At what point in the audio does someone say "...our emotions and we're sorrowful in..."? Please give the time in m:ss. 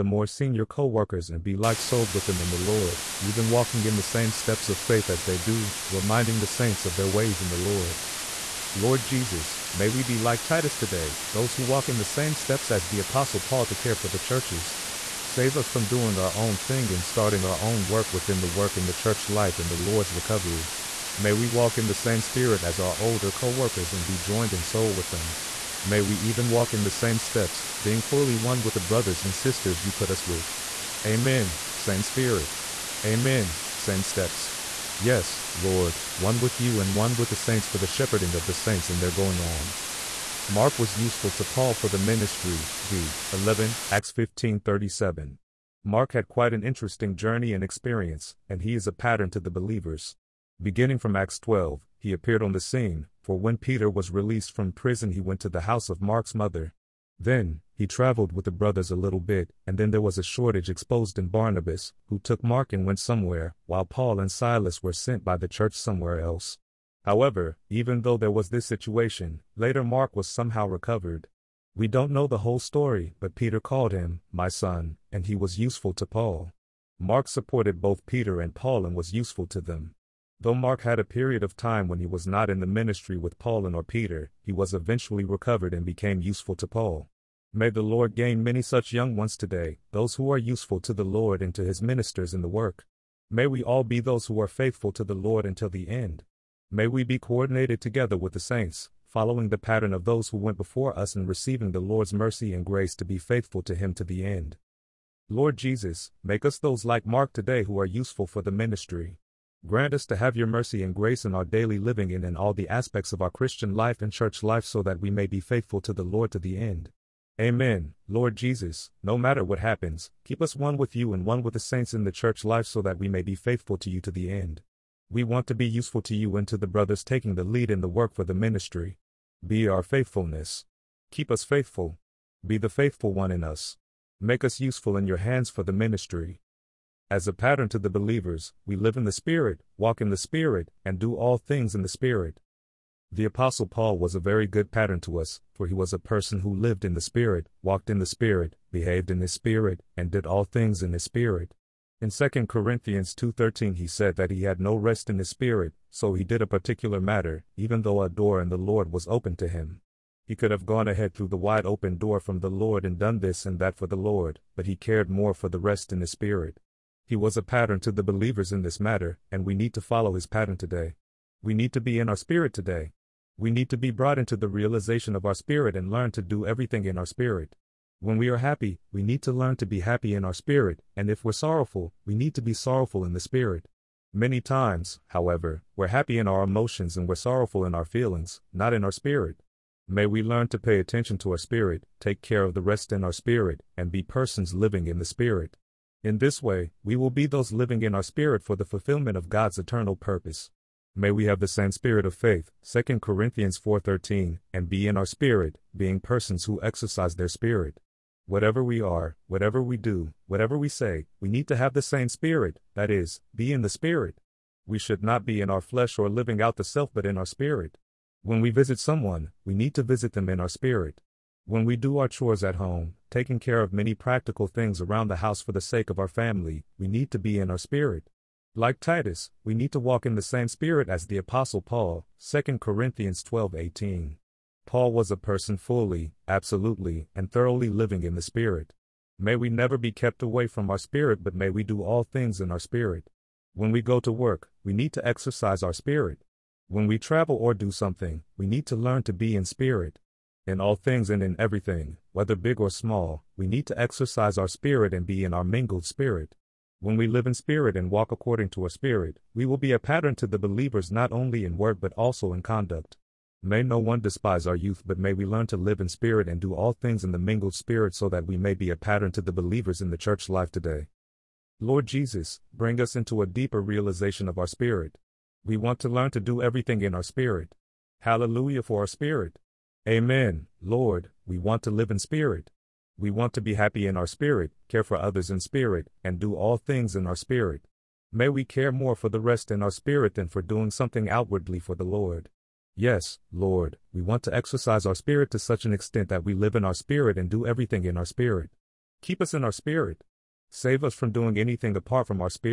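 3:06.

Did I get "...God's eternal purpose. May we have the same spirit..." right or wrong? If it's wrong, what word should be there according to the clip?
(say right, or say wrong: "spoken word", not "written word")
right.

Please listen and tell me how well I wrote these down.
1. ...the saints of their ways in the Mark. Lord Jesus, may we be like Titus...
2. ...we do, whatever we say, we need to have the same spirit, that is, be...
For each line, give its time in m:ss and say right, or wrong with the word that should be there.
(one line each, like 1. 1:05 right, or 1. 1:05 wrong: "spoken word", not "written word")
1. 0:06 wrong: "Lord", not "Mark"
2. 3:29 right.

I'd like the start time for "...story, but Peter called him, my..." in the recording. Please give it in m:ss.
1:12.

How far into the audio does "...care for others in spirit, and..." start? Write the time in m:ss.
4:44.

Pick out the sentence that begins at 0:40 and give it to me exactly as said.
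Mark was useful to Paul for the ministry, v.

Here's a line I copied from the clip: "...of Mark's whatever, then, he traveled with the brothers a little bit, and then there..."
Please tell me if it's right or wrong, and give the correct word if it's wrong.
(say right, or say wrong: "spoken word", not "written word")
wrong: "mother", not "whatever".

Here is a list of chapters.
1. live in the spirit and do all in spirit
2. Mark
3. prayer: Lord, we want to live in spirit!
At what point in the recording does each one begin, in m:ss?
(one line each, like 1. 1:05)
1. 2:16
2. 0:39
3. 4:31.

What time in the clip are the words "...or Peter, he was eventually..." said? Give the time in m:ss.
1:23.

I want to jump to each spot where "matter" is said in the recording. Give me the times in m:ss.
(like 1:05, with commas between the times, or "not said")
1:59, 2:37, 2:48.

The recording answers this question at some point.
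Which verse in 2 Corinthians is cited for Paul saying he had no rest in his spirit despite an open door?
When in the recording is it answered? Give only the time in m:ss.
2:32.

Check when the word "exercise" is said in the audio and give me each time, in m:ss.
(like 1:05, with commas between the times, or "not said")
3:26, 4:05, 4:13, 4:54.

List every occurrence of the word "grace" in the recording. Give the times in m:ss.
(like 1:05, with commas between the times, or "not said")
1:42, 1:50.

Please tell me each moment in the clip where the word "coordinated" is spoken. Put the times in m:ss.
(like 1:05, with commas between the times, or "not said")
1:37.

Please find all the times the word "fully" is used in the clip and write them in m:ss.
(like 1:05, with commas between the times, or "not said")
0:28, 3:55.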